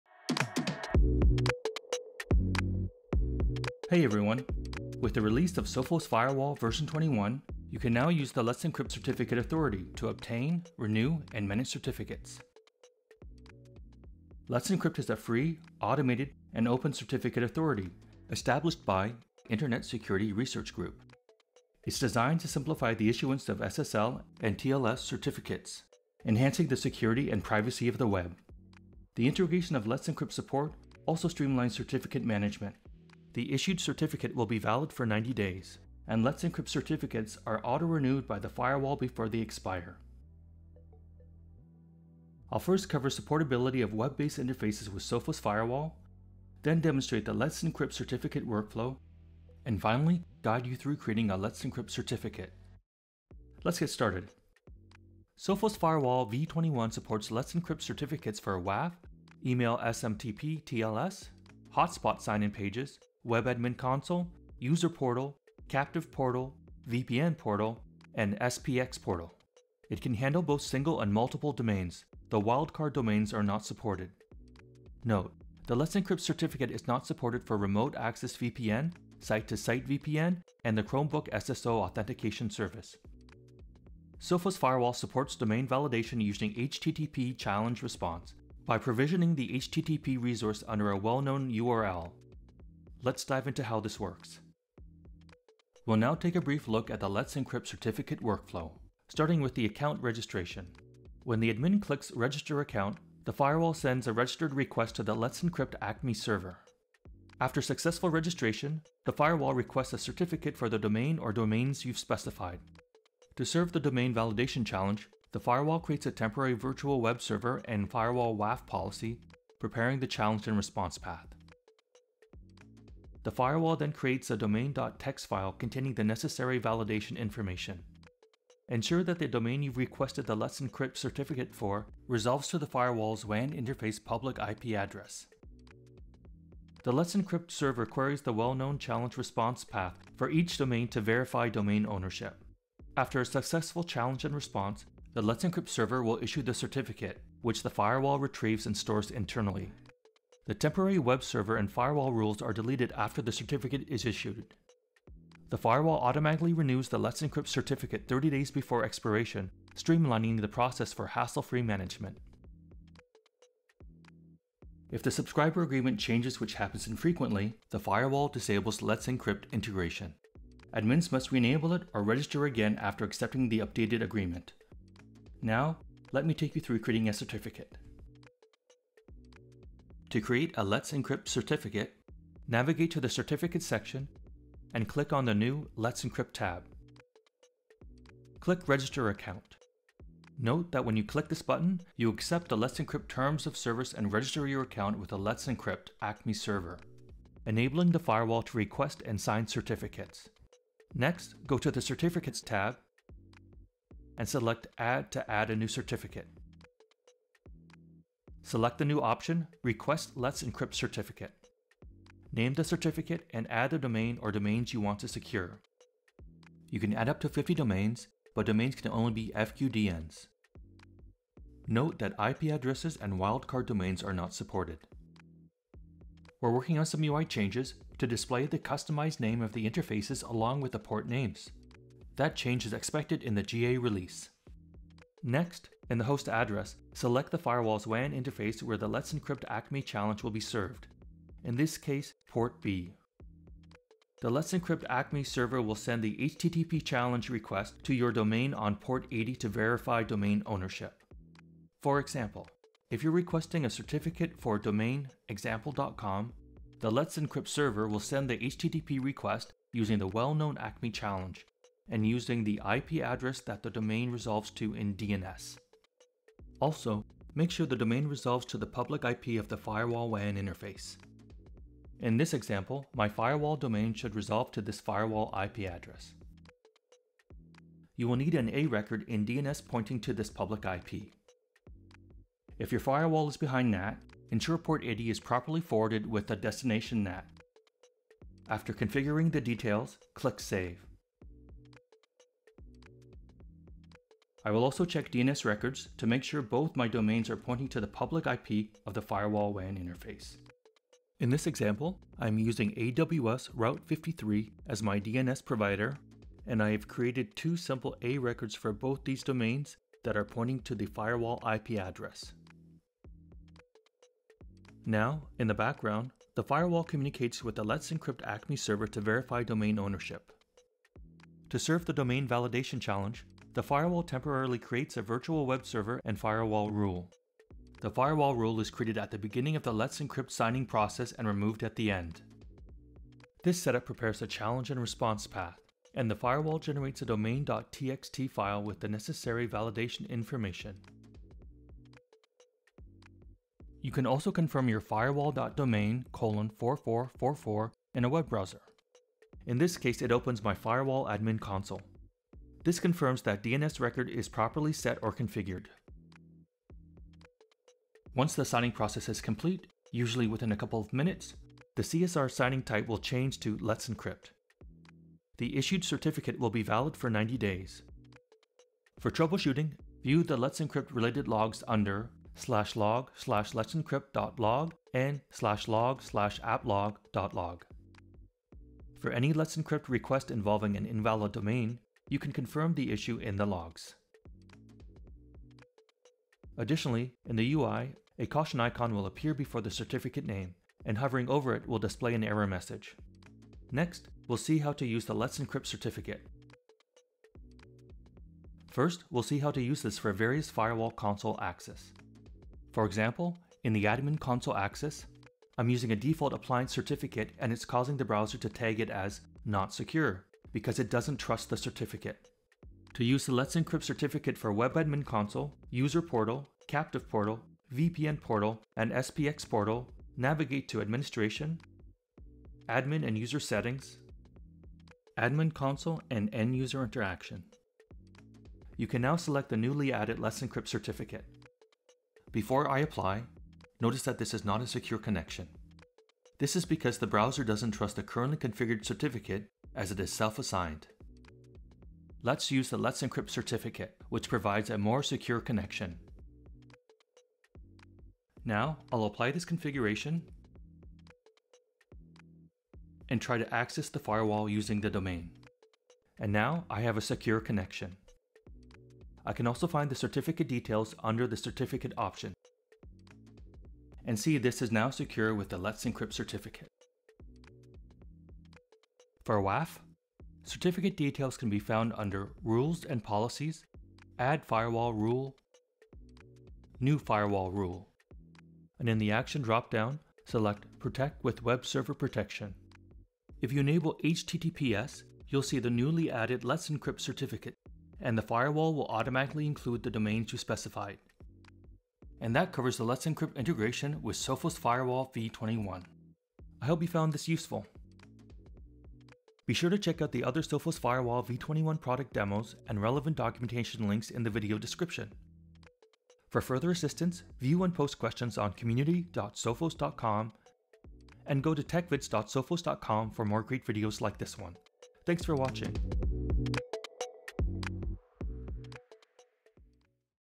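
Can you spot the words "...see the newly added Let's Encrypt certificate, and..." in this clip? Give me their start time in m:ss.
8:05.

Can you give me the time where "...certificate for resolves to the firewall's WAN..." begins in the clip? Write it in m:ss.
2:10.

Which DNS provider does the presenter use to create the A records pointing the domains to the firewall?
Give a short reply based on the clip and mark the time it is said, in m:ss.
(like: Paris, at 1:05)
AWS Route 53, at 5:02.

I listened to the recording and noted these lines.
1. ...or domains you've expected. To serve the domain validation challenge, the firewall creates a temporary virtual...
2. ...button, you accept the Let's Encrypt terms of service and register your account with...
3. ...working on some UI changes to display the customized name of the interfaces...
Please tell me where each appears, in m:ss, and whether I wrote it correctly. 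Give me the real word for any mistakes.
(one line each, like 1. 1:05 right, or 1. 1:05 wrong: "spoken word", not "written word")
1. 1:51 wrong: "specified", not "expected"
2. 3:11 right
3. 3:46 right.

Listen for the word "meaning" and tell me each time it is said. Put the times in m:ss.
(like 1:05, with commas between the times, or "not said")
not said.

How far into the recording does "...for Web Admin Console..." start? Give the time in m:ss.
6:54.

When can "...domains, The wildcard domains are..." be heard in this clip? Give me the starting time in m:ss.
1:11.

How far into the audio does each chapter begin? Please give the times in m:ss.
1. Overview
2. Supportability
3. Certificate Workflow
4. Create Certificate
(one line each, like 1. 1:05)
1. 0:13
2. 0:55
3. 1:35
4. 2:59.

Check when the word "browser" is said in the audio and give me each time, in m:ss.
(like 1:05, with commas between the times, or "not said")
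5:48, 6:48, 7:17.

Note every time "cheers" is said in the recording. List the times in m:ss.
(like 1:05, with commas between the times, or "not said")
not said.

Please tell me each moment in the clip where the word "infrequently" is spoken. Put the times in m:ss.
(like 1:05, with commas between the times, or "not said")
2:46.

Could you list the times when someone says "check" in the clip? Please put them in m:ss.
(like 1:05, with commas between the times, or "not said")
4:54, 8:19.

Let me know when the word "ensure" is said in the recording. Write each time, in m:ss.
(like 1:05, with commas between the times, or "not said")
2:08, 4:44.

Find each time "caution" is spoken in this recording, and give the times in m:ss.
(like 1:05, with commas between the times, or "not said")
6:28.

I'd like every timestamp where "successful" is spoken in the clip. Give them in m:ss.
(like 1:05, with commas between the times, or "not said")
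1:47, 2:23.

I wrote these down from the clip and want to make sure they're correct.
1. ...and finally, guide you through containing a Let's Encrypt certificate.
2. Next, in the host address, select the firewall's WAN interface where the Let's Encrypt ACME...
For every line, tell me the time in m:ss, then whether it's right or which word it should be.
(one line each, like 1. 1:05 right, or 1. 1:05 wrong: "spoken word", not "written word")
1. 0:49 wrong: "creating", not "containing"
2. 3:55 right.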